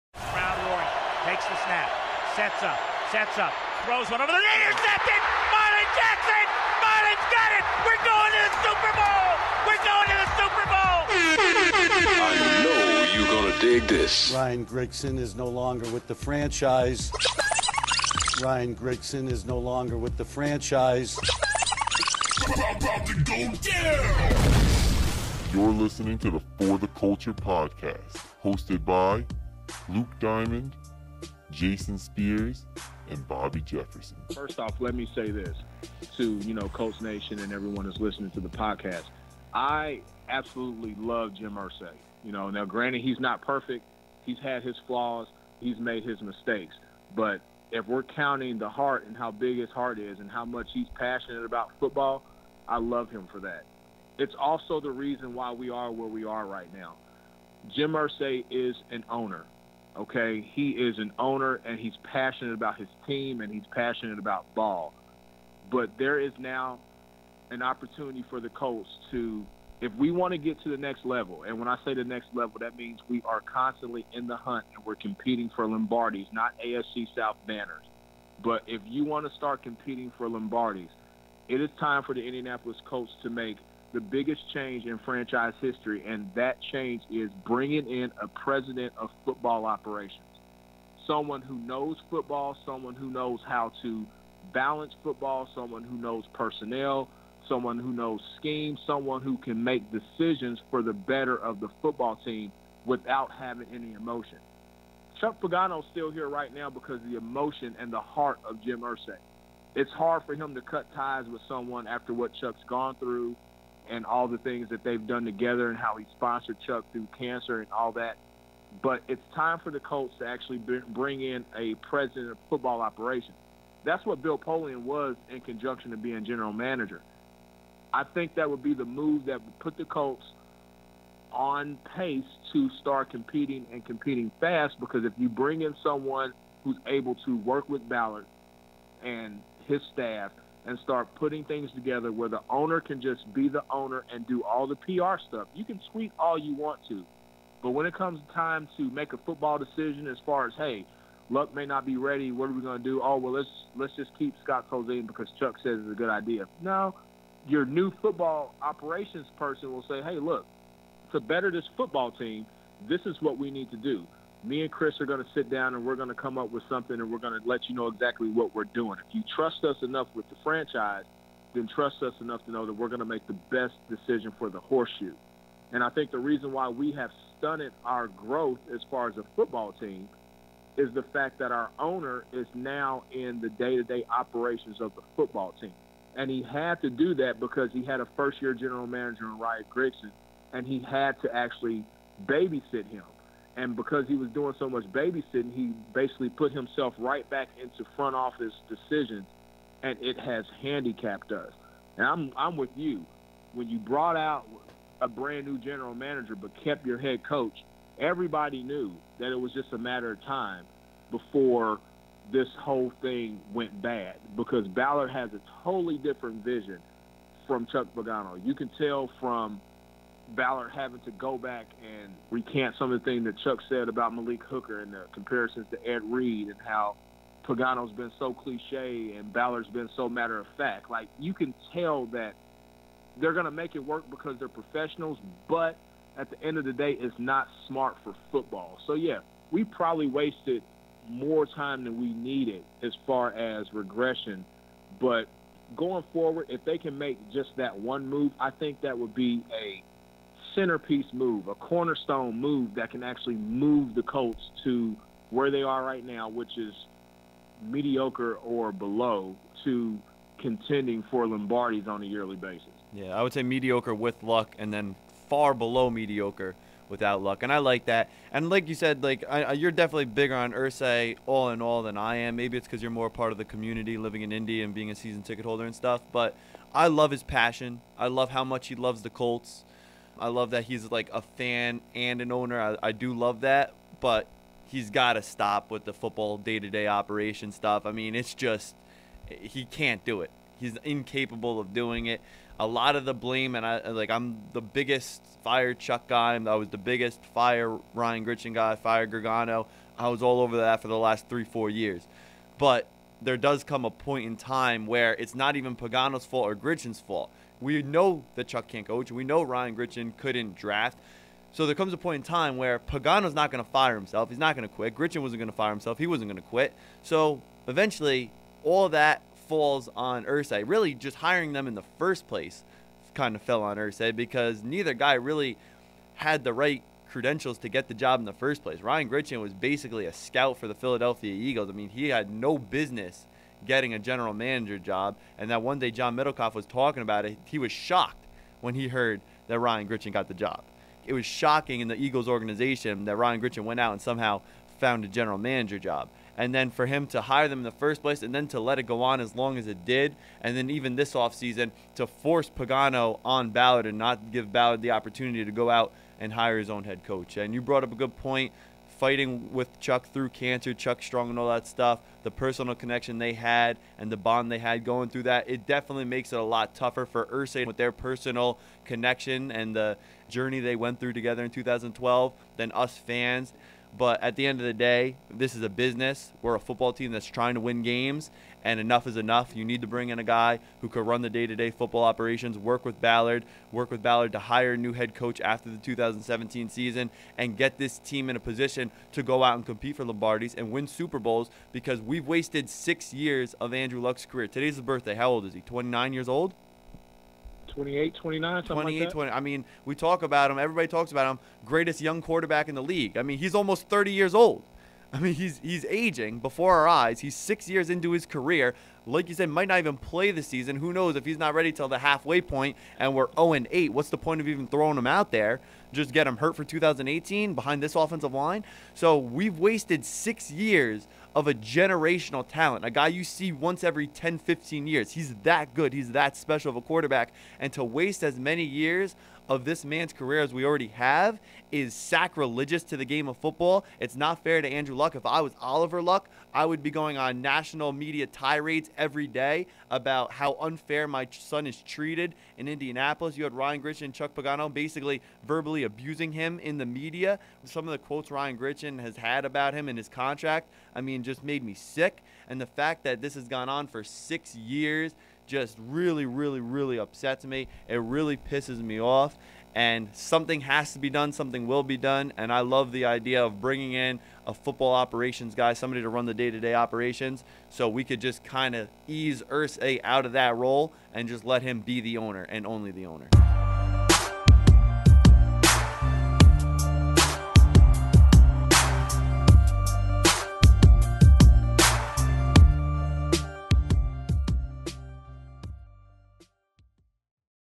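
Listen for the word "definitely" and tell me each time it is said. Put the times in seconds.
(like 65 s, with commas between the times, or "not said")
269 s, 365 s.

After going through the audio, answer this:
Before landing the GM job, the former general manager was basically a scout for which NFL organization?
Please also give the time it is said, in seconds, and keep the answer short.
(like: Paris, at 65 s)
Philadelphia Eagles, at 330 s.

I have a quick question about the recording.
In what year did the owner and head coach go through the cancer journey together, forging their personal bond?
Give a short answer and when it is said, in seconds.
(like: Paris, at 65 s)
2012, at 371 s.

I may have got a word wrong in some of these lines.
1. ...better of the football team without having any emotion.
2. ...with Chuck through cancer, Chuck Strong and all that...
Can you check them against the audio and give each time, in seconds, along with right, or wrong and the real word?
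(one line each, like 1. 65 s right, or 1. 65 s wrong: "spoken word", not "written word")
1. 100 s right
2. 359 s right.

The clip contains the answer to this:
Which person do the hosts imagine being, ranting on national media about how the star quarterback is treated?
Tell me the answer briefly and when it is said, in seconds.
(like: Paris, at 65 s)
Oliver Luck, at 435 s.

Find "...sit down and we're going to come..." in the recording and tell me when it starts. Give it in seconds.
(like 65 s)
165 s.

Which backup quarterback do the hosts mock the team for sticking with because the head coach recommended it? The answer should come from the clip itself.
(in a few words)
Scott Tolzien.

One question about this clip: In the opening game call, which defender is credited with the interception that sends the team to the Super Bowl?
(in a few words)
Marlin Jackson.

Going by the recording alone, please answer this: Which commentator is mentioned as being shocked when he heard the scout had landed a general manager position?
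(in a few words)
John Middlekauff.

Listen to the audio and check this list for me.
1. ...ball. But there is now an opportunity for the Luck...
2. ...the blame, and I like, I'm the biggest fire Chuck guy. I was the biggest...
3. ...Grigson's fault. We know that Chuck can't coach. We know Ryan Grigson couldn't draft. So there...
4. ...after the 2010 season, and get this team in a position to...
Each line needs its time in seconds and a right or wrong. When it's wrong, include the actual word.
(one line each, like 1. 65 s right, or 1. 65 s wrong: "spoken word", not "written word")
1. 64 s wrong: "Colts", not "Luck"
2. 293 s right
3. 306 s right
4. 385 s wrong: "2017", not "2010".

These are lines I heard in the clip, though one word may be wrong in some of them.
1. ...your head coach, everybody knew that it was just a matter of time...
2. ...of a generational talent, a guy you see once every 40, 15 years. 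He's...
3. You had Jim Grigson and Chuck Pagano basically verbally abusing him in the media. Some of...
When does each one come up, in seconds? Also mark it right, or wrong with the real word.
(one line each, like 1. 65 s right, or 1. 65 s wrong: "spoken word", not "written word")
1. 206 s right
2. 421 s wrong: "10", not "40"
3. 443 s wrong: "Ryan", not "Jim".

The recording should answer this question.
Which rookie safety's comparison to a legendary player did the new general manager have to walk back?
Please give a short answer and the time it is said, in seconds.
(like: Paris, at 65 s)
Malik Hooker, at 224 s.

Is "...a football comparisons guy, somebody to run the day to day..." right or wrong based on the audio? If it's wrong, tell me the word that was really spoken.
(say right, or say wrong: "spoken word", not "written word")
wrong: "operations", not "comparisons".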